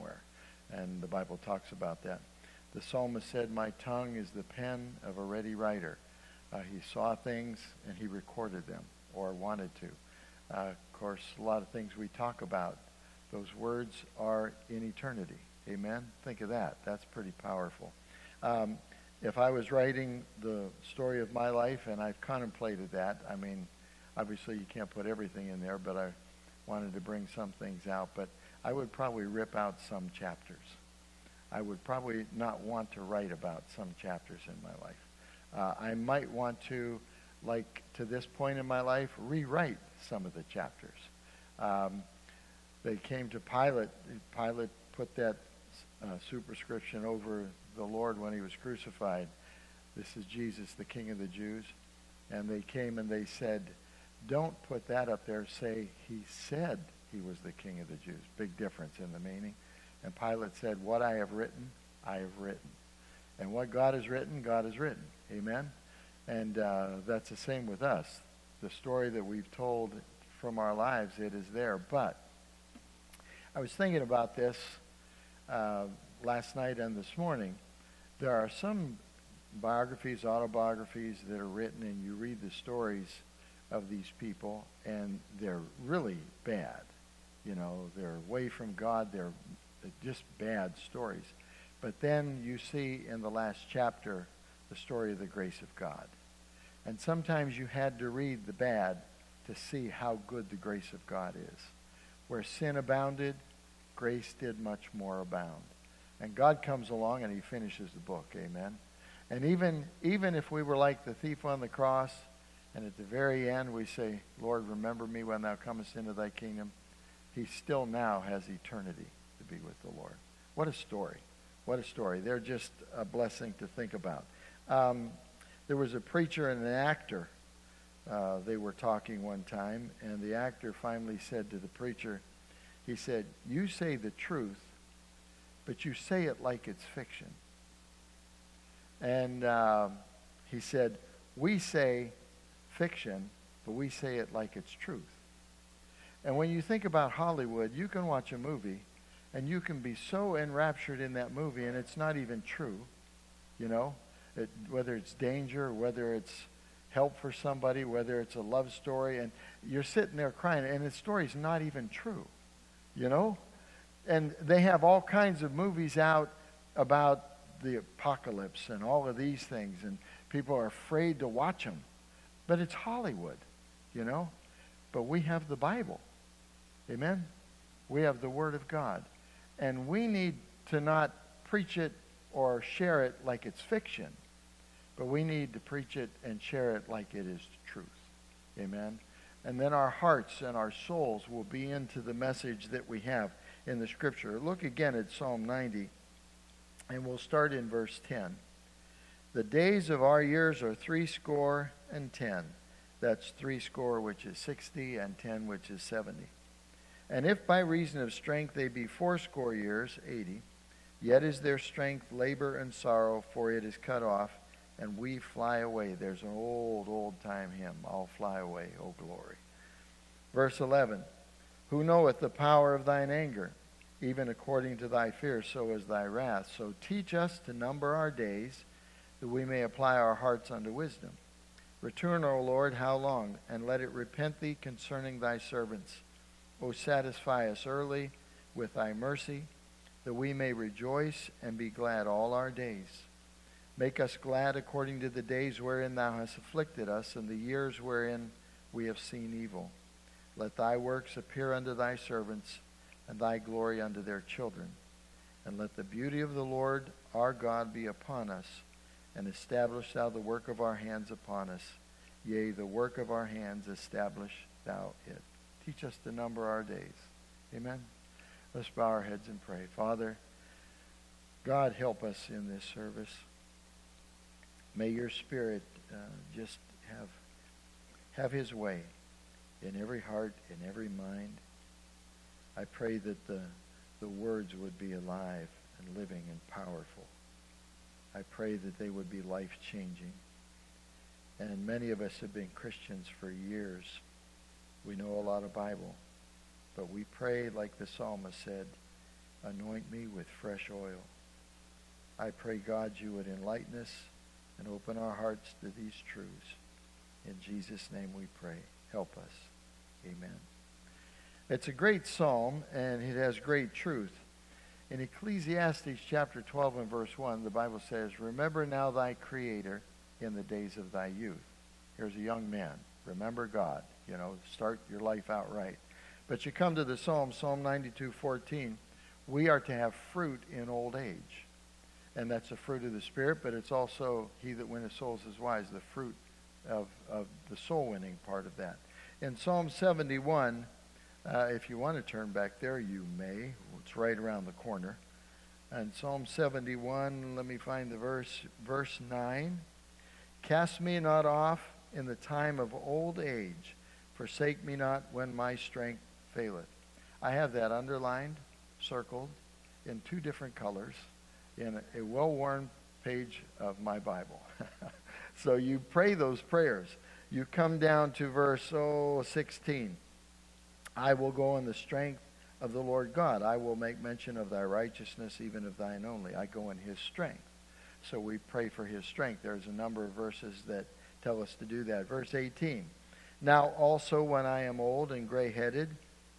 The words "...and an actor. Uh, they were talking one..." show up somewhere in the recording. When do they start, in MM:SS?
02:06.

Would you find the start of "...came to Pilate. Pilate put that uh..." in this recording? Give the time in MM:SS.
00:42.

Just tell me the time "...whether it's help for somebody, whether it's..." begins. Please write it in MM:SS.
02:35.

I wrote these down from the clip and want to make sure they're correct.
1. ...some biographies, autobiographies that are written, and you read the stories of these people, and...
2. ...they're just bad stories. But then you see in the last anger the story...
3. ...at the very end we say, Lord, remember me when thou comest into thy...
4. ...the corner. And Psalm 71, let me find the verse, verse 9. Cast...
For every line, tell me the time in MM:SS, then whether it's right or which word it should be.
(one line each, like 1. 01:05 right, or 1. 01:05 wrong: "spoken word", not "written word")
1. 01:18 right
2. 01:29 wrong: "chapter", not "anger"
3. 01:52 right
4. 05:44 right.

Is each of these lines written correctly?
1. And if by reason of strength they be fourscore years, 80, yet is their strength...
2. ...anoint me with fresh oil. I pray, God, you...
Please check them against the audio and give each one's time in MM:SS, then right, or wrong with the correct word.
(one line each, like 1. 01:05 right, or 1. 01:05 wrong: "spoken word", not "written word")
1. 03:27 right
2. 04:59 right.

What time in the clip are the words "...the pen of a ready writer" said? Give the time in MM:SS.
00:04.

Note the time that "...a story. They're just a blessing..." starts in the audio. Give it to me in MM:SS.
02:01.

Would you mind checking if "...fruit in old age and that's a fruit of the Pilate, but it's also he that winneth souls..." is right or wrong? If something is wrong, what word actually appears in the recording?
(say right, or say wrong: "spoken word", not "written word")
wrong: "Spirit", not "Pilate".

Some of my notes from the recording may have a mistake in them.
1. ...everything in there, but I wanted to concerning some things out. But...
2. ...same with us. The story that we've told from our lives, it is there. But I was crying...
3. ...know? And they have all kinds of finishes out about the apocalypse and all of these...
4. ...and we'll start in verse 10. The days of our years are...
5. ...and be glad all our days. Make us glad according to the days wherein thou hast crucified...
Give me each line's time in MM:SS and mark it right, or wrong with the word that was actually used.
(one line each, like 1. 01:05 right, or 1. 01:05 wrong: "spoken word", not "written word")
1. 00:25 wrong: "bring", not "concerning"
2. 01:07 wrong: "thinking", not "crying"
3. 02:43 wrong: "movies", not "finishes"
4. 03:16 right
5. 04:01 wrong: "afflicted", not "crucified".